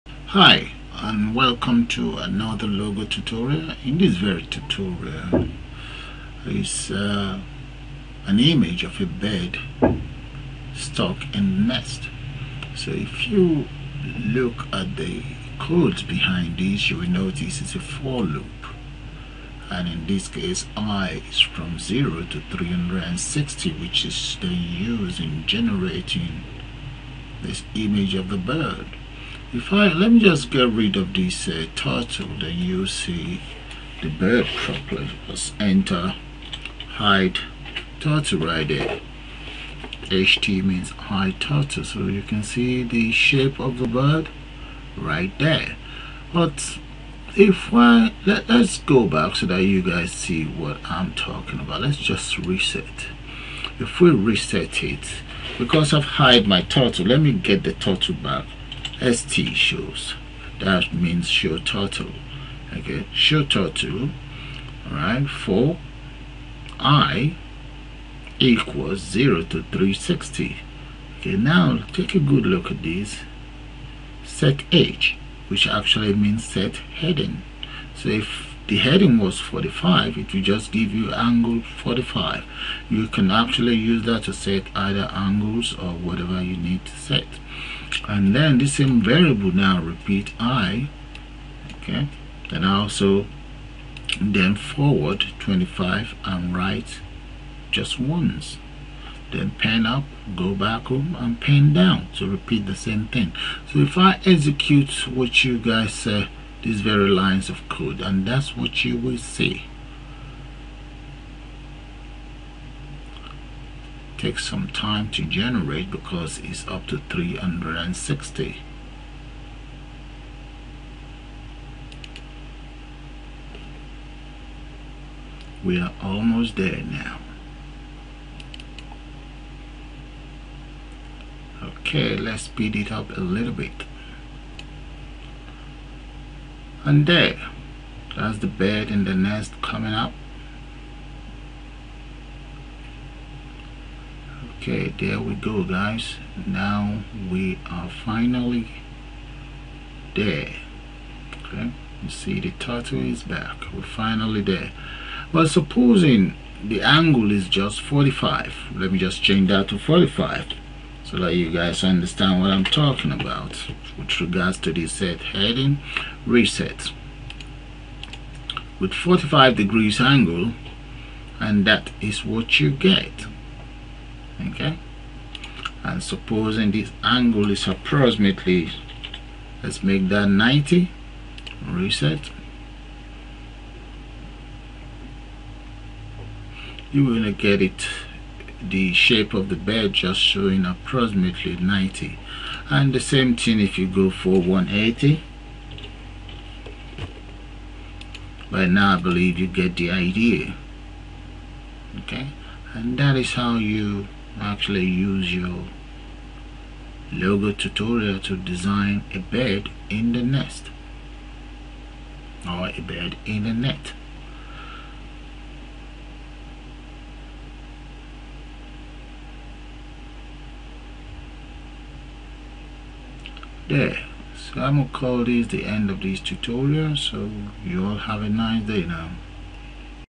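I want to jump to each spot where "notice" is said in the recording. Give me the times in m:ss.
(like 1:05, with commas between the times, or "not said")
0:17.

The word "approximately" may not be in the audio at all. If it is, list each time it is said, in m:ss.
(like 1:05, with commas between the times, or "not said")
2:57, 3:10.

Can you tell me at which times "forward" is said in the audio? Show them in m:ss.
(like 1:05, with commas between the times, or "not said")
1:34.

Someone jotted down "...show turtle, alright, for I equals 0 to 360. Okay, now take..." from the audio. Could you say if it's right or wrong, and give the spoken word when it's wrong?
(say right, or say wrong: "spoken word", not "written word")
right.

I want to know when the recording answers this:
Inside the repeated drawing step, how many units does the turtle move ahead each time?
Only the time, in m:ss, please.
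1:34.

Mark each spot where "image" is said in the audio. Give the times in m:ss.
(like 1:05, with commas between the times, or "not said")
0:08, 0:27.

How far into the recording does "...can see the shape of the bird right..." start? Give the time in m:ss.
0:42.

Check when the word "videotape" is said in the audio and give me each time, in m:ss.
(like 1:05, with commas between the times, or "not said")
not said.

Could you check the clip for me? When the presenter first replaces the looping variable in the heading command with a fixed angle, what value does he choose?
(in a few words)
45.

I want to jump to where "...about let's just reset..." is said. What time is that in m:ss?
0:51.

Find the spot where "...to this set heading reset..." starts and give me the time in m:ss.
2:44.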